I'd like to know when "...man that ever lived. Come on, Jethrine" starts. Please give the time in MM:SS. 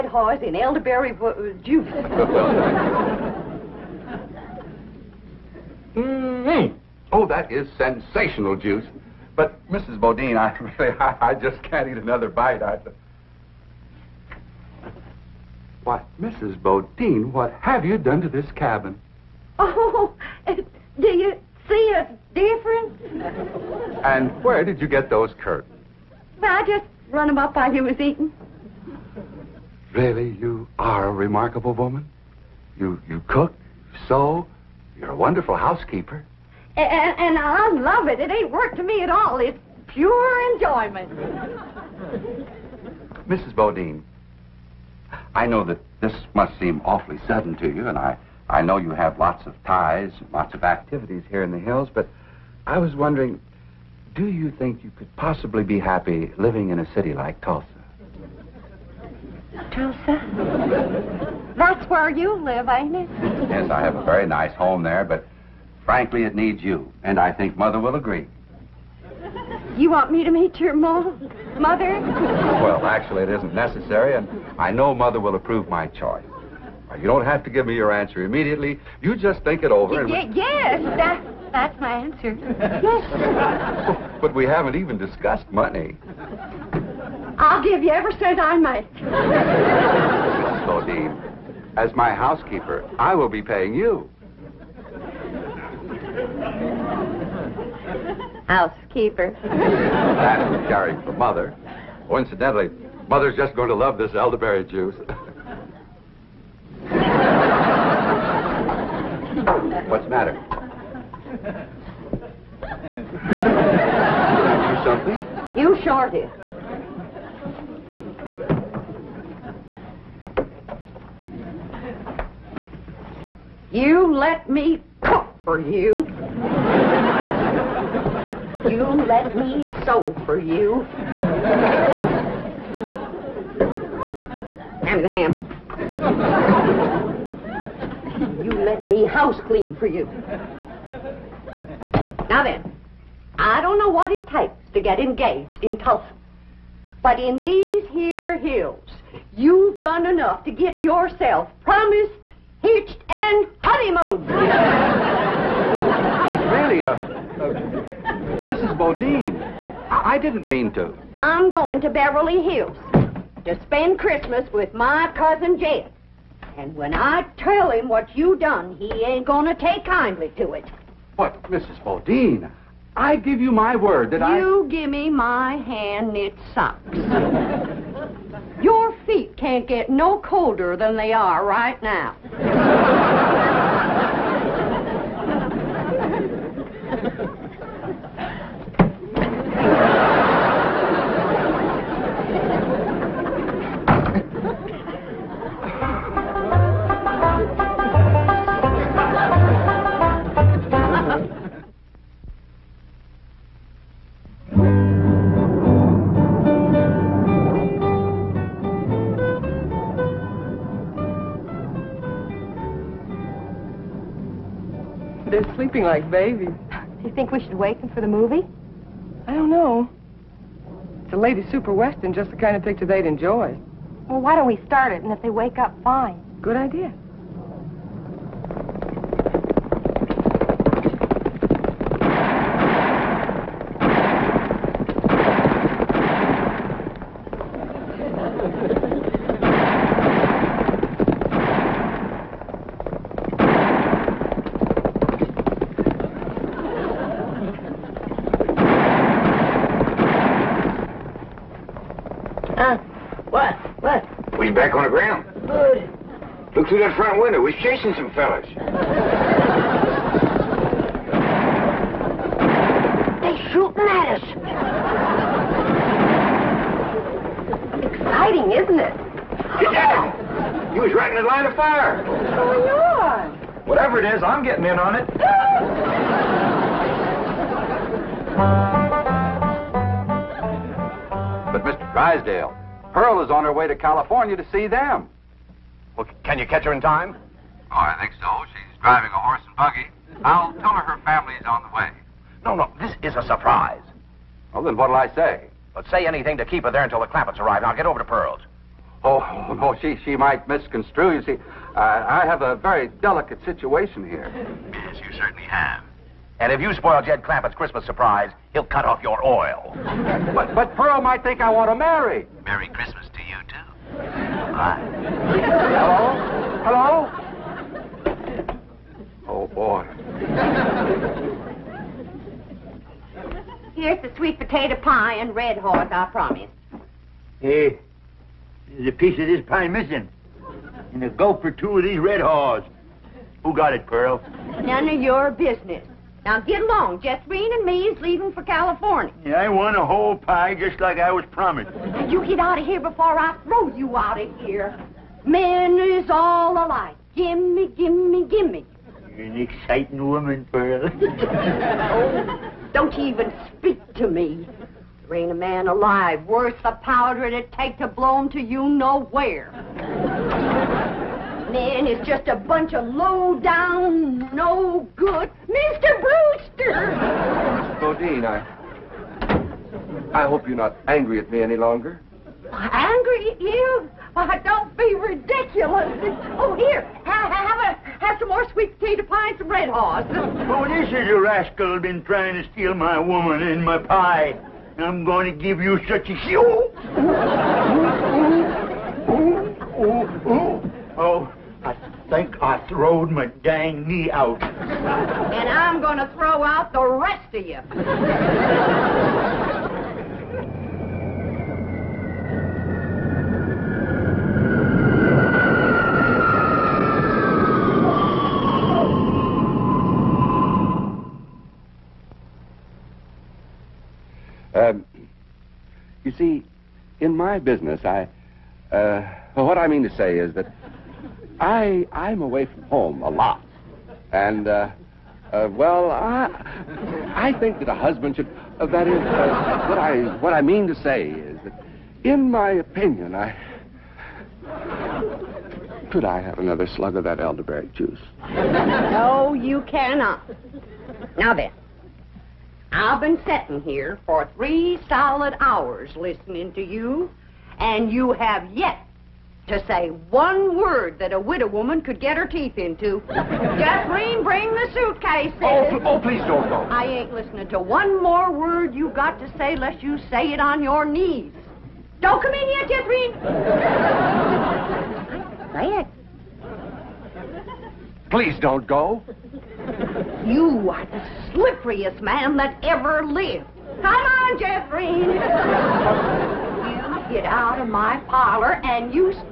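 07:52.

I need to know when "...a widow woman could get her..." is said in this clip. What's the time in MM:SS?
07:31.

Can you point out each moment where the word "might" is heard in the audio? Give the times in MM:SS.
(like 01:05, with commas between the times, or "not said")
05:00, 05:10.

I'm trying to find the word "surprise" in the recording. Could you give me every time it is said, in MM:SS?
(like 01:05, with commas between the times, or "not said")
04:53, 05:07.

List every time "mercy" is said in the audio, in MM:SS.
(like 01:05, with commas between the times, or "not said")
not said.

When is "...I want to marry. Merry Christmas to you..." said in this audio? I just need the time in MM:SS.
05:11.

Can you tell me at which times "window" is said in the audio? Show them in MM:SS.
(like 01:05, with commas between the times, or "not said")
04:17.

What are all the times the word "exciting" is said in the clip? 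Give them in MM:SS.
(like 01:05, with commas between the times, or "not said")
04:27, 05:49.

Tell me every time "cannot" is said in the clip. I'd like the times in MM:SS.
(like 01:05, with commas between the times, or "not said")
07:19.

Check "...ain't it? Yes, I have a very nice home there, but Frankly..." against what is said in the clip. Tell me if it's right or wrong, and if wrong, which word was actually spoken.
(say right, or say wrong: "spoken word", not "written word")
right.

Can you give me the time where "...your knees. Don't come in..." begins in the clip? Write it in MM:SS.
07:40.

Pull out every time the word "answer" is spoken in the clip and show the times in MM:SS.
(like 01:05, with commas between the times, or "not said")
01:17, 01:21.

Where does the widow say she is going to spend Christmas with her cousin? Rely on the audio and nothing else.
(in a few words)
Beverly Hills.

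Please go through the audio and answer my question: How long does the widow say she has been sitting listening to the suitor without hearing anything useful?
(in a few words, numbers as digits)
3 hours.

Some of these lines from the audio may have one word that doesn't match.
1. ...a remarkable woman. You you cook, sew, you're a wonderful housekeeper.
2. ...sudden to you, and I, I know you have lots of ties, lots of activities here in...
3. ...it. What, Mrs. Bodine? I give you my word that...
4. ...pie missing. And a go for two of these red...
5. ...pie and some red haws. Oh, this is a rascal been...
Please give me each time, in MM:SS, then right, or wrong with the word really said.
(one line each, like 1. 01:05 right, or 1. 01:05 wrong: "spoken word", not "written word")
1. 00:31 right
2. 00:47 right
3. 02:50 right
4. 05:29 right
5. 06:19 right.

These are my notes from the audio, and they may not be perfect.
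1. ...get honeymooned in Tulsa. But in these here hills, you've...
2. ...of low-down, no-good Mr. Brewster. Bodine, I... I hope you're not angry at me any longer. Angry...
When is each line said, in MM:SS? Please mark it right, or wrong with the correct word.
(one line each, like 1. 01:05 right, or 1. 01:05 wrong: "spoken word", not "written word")
1. 02:24 wrong: "engaged", not "honeymooned"
2. 06:02 right.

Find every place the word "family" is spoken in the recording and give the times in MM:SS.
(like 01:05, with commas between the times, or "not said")
04:51.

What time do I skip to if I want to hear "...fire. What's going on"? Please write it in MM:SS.
04:31.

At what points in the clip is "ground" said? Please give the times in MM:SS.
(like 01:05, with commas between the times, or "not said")
04:14.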